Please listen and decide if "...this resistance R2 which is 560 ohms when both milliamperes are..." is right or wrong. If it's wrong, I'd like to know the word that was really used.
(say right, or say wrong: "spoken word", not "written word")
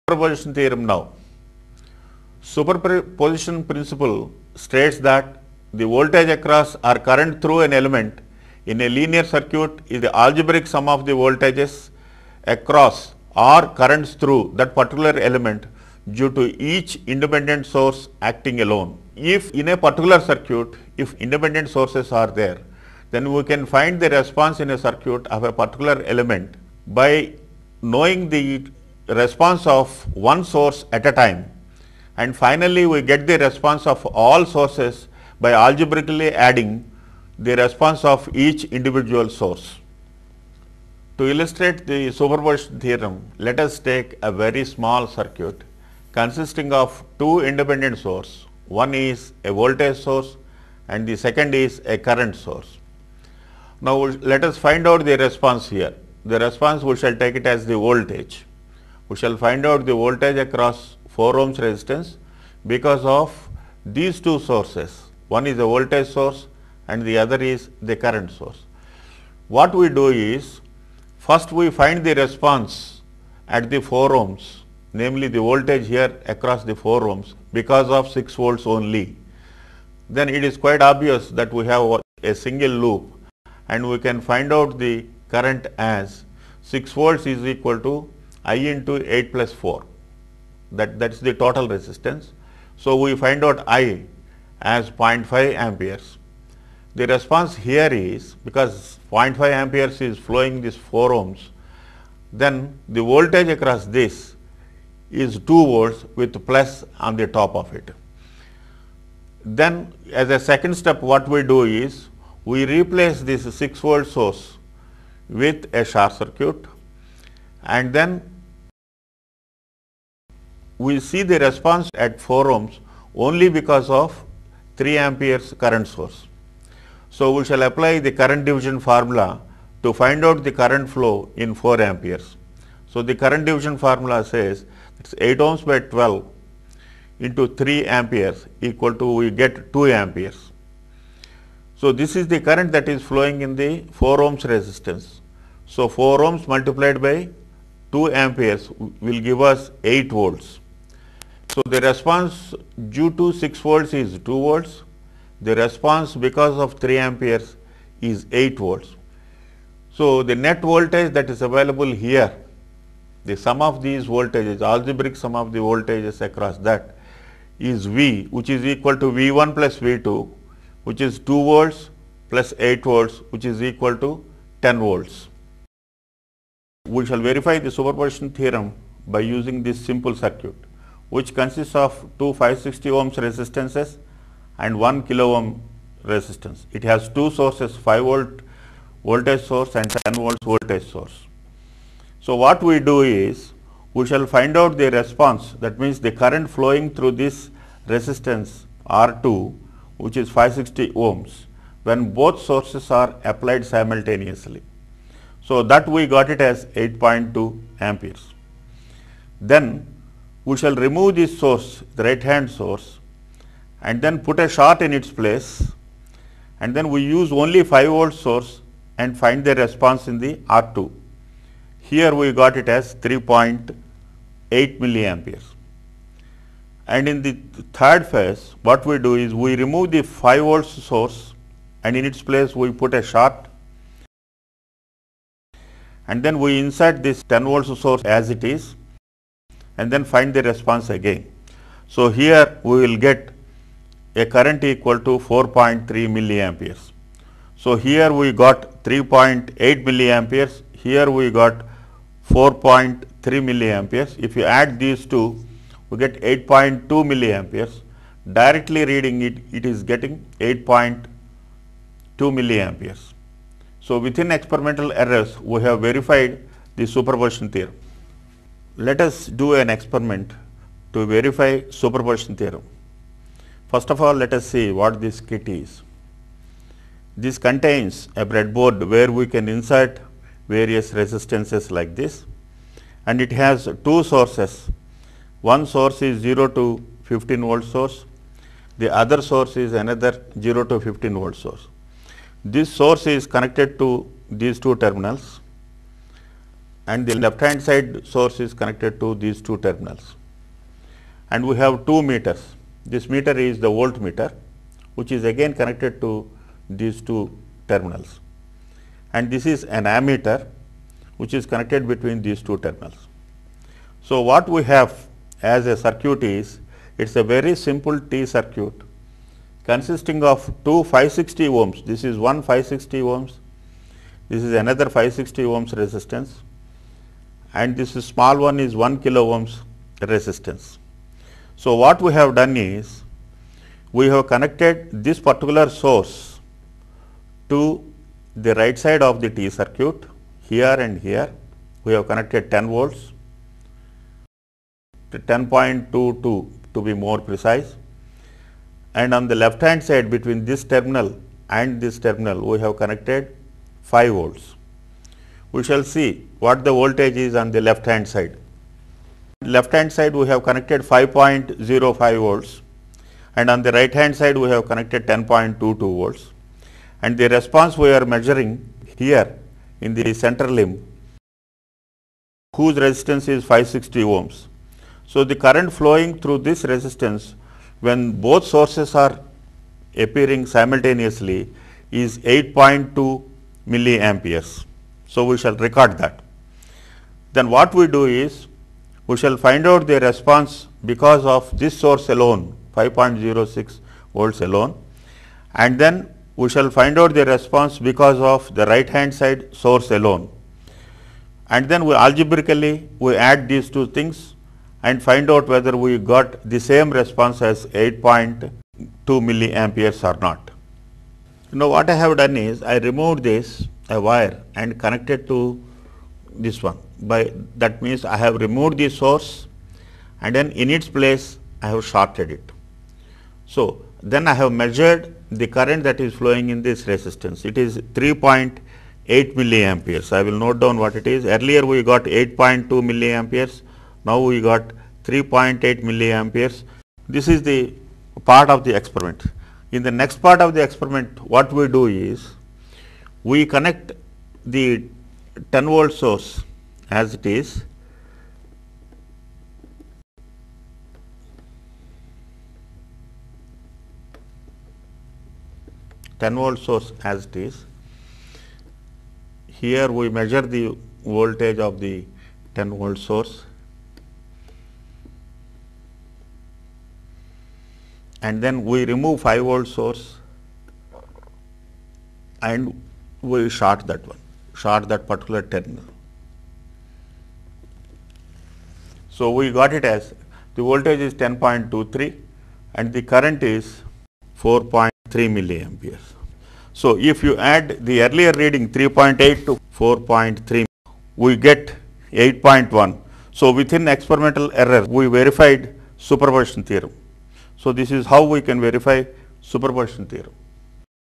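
wrong: "sources", not "milliamperes".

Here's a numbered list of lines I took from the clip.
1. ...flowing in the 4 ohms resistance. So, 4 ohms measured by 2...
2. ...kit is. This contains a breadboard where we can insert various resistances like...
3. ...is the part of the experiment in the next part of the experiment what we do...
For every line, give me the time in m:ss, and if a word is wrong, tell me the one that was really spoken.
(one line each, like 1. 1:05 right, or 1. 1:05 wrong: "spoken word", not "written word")
1. 2:23 wrong: "multiplied", not "measured"
2. 4:35 right
3. 7:17 right.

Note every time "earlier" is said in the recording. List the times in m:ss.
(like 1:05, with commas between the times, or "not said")
7:11, 8:08.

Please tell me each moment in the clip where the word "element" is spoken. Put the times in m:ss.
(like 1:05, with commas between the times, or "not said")
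0:07, 0:15, 0:26.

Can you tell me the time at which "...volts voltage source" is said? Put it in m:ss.
3:10.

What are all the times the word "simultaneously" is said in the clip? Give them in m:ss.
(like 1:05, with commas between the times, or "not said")
3:23, 6:20.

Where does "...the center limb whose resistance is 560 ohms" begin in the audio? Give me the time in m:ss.
6:09.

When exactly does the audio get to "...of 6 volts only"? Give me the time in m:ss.
1:17.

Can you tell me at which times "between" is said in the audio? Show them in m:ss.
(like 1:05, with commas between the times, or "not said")
5:11, 5:50.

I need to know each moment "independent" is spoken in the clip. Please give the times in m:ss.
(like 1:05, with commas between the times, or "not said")
0:17, 0:21, 0:47.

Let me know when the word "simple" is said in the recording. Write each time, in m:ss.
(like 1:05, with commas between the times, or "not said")
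2:59, 5:17.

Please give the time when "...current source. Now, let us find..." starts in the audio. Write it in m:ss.
0:51.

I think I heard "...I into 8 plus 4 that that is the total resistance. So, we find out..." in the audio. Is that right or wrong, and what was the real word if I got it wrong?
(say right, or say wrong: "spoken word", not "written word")
right.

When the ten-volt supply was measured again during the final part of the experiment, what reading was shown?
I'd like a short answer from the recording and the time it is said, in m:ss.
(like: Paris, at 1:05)
10.23, at 8:01.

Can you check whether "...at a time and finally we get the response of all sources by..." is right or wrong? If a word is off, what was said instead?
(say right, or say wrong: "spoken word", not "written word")
right.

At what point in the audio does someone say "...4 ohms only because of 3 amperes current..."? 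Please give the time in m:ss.
2:02.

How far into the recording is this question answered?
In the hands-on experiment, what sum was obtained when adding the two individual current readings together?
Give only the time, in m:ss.
8:12.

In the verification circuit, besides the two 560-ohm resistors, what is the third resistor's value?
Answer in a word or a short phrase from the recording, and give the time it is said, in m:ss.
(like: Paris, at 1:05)
1 kilo ohm, at 3:04.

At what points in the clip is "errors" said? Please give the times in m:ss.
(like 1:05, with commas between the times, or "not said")
4:24, 8:14.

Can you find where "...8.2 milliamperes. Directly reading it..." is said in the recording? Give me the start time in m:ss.
4:16.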